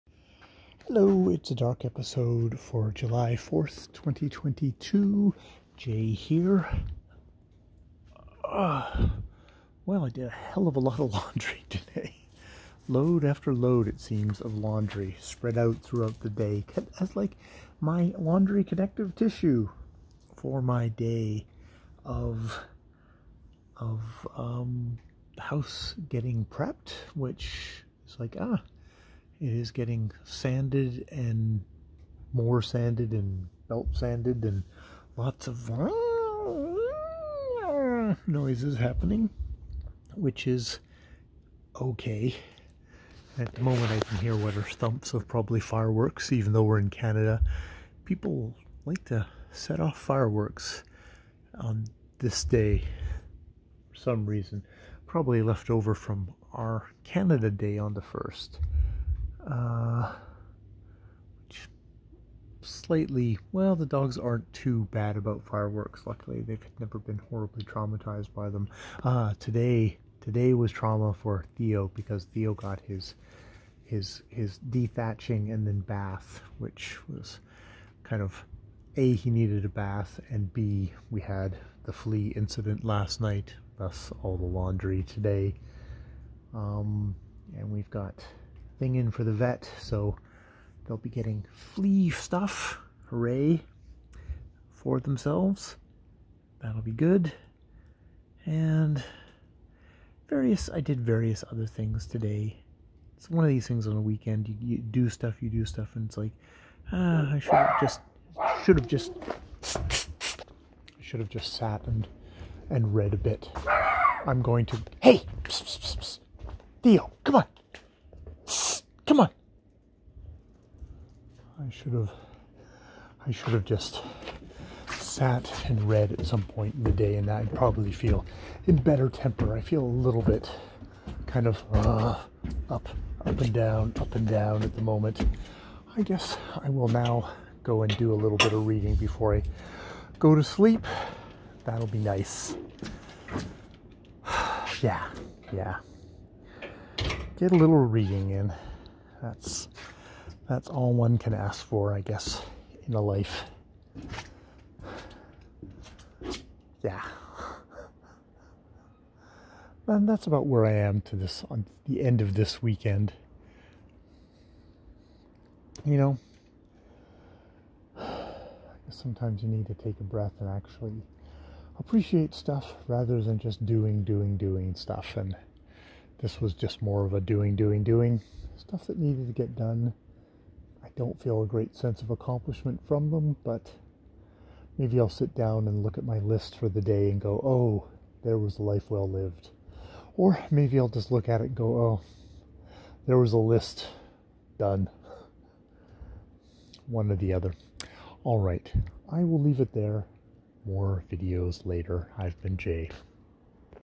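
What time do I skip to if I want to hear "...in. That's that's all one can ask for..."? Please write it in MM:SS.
02:28.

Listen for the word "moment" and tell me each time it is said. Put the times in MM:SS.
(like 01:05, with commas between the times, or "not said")
00:43, 02:14.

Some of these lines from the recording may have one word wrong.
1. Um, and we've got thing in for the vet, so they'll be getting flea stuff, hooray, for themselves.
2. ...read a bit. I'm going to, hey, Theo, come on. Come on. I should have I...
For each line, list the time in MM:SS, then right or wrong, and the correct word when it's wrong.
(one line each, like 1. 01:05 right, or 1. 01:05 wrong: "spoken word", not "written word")
1. 01:26 right
2. 01:52 right.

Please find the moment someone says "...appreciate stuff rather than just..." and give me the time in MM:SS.
02:51.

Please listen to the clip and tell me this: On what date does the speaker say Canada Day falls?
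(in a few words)
the 1st.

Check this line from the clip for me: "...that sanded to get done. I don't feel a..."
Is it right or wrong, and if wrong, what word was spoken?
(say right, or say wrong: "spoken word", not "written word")
wrong: "needed", not "sanded".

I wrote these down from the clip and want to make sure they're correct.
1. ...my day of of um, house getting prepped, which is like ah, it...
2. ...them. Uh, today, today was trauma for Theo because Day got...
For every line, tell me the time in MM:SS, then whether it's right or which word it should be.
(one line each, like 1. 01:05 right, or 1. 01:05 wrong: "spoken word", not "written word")
1. 00:20 right
2. 01:08 wrong: "Theo", not "Day".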